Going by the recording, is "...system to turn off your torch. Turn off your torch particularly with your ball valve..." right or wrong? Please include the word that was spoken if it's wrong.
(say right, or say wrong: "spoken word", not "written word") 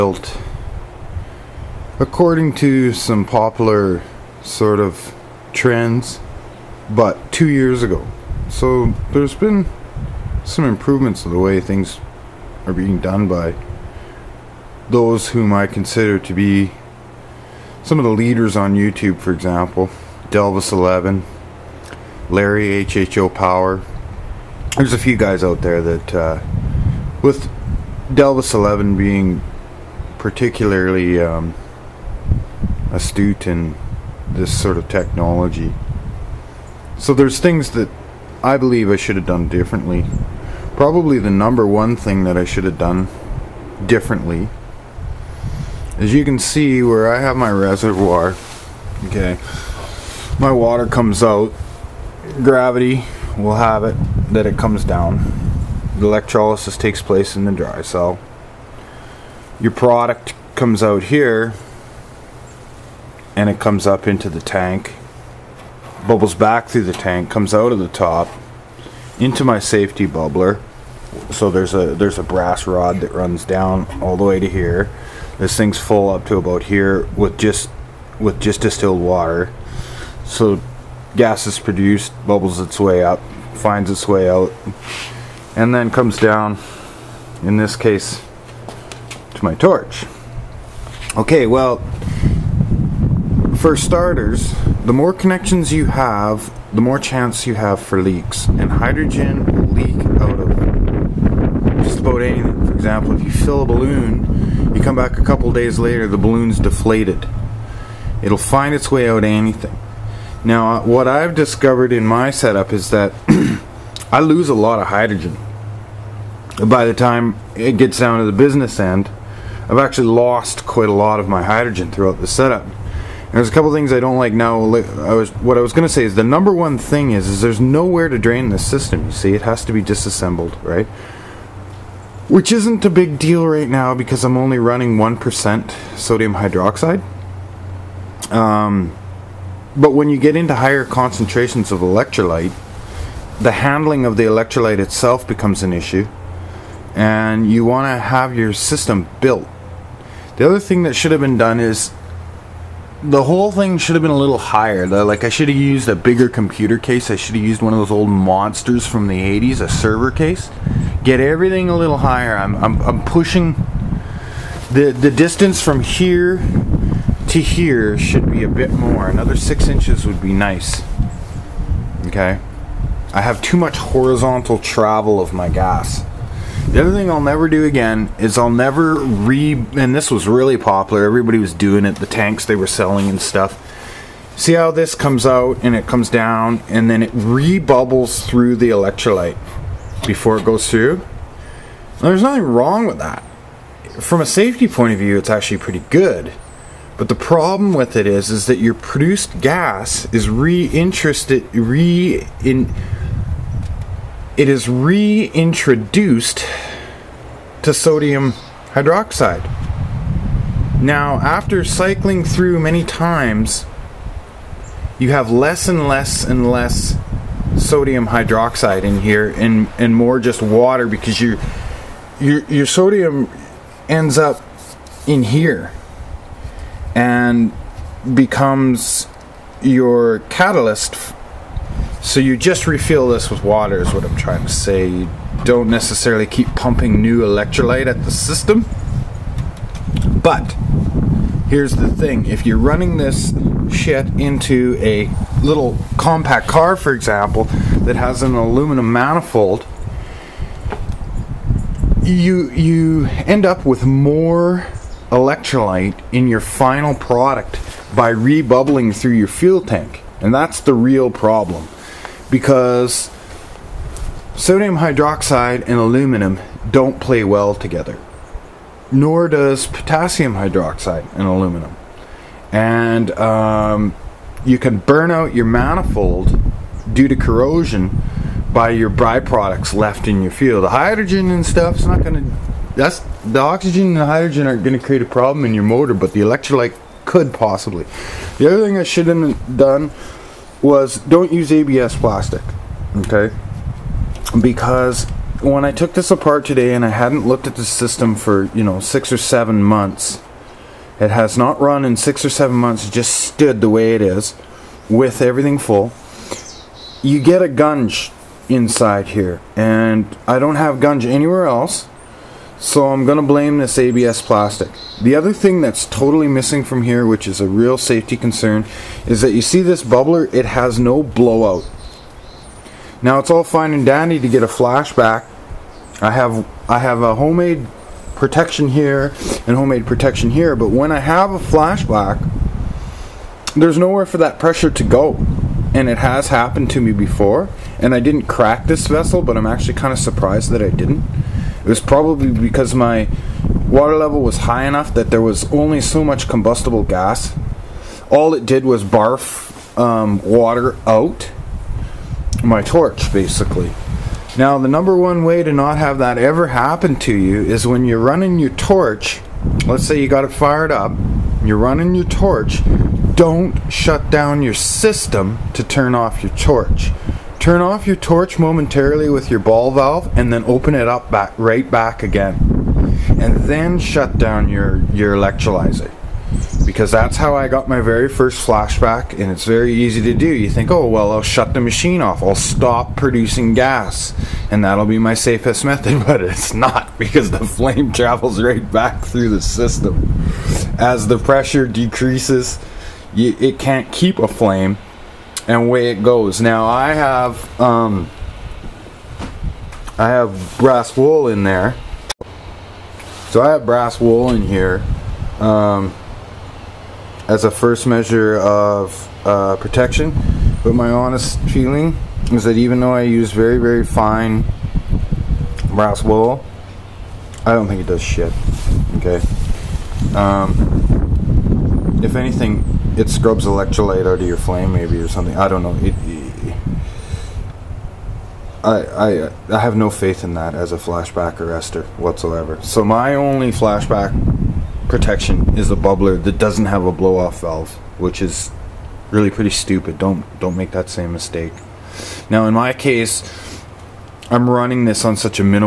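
wrong: "momentarily", not "particularly".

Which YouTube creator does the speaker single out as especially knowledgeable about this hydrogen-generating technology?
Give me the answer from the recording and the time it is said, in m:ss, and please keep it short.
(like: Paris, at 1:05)
Delvis11, at 0:28.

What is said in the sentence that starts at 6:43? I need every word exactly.
So I have brass wool in here um, as a first measure of uh, protection.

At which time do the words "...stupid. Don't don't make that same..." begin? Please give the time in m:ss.
7:19.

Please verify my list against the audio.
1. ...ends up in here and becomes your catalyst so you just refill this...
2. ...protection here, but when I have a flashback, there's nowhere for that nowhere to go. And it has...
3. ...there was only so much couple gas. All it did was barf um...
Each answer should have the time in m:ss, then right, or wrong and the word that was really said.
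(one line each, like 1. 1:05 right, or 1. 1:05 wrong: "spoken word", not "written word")
1. 3:43 right
2. 5:29 wrong: "pressure", not "nowhere"
3. 5:45 wrong: "combustible", not "couple".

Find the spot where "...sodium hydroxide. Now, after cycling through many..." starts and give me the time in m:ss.
3:27.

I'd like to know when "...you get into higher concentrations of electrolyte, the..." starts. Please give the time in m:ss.
2:20.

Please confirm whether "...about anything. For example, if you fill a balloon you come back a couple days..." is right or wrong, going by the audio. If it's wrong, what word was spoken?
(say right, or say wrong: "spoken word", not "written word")
right.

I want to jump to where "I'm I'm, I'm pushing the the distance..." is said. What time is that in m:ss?
2:42.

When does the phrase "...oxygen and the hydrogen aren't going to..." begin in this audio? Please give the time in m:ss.
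4:43.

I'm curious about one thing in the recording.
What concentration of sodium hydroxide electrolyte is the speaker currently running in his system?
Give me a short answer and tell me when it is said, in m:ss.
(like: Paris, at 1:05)
1%, at 2:14.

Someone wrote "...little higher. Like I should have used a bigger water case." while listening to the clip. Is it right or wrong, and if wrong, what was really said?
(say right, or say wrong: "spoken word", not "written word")
wrong: "computer", not "water".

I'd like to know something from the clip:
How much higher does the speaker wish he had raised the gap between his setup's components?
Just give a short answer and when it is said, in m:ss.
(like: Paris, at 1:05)
6 inches, at 2:49.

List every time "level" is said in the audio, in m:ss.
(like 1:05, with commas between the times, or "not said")
5:43.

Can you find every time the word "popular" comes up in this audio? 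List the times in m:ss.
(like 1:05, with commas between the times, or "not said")
0:03, 3:00.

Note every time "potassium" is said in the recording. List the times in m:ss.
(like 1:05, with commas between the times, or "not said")
4:29.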